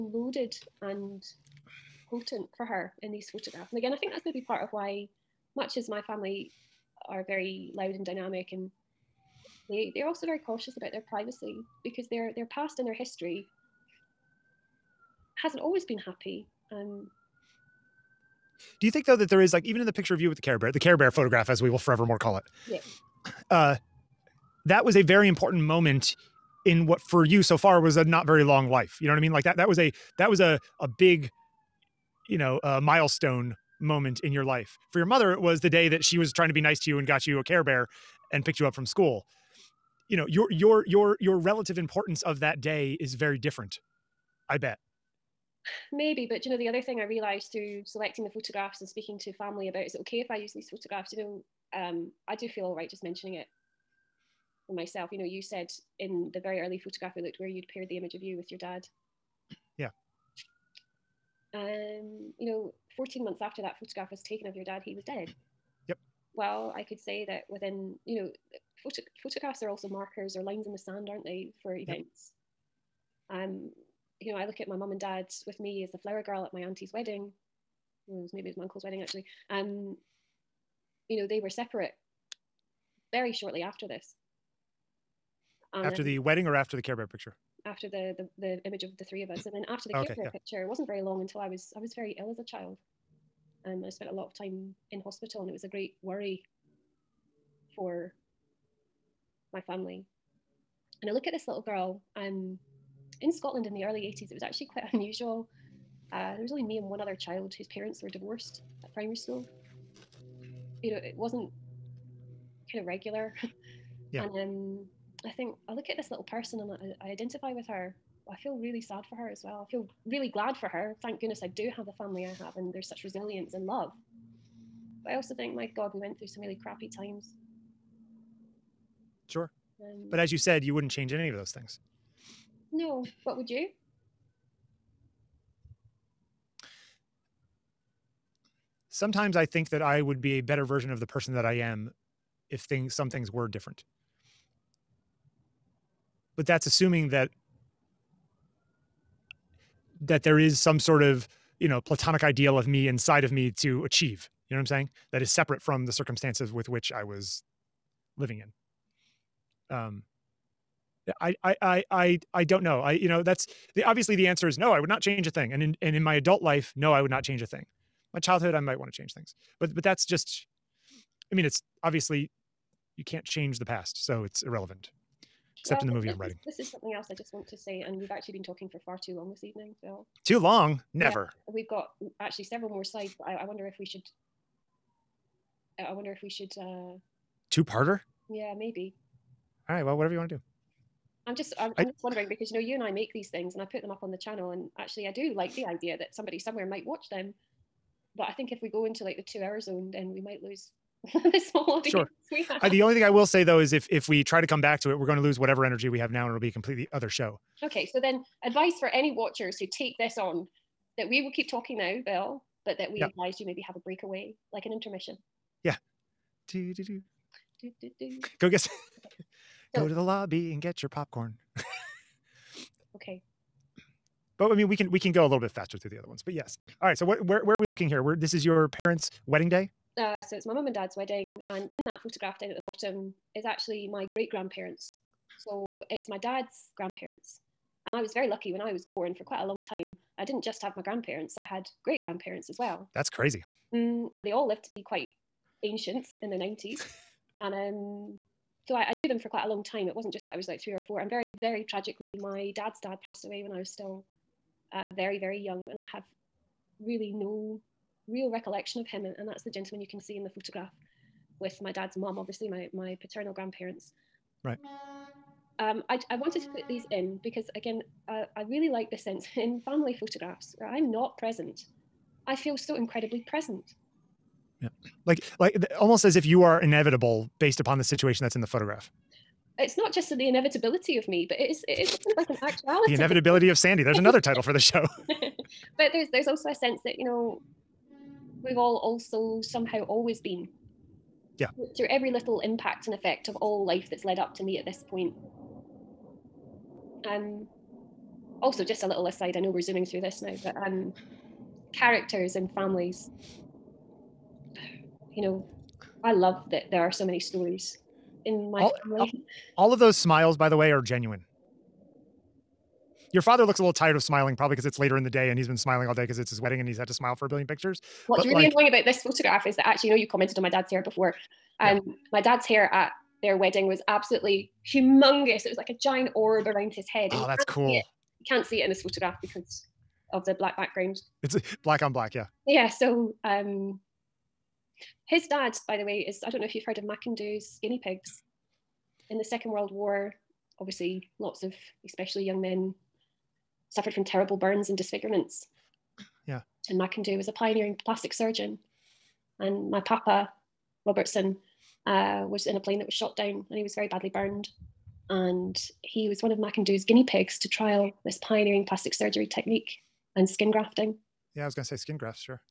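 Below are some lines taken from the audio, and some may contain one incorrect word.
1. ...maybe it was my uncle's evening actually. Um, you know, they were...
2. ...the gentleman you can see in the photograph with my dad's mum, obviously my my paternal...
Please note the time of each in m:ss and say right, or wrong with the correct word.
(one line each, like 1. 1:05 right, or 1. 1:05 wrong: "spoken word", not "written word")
1. 1:18 wrong: "wedding", not "evening"
2. 4:19 right.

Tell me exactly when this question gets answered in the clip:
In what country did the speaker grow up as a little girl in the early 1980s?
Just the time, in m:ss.
1:43.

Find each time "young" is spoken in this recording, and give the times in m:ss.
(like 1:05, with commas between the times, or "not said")
4:15, 5:42.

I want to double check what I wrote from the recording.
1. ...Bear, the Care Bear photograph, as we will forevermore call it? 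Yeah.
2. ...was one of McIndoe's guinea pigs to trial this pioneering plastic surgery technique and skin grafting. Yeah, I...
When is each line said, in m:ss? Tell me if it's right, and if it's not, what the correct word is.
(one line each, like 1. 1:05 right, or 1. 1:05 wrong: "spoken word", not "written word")
1. 0:20 right
2. 5:56 right.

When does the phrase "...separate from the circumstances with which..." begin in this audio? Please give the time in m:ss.
2:35.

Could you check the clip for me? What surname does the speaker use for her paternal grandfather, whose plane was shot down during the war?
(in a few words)
Robertson.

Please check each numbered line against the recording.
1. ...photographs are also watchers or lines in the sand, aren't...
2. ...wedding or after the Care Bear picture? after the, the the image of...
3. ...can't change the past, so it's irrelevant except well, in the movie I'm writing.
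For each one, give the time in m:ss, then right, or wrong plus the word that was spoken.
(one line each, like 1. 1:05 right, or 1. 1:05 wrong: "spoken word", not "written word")
1. 1:09 wrong: "markers", not "watchers"
2. 1:26 right
3. 2:53 right.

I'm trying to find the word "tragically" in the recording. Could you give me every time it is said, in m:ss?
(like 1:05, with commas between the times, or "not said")
4:11.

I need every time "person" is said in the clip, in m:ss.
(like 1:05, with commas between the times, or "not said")
1:56, 2:21.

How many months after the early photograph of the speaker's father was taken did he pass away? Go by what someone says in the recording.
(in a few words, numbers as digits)
14.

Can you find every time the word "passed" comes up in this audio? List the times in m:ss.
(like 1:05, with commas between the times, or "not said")
4:13.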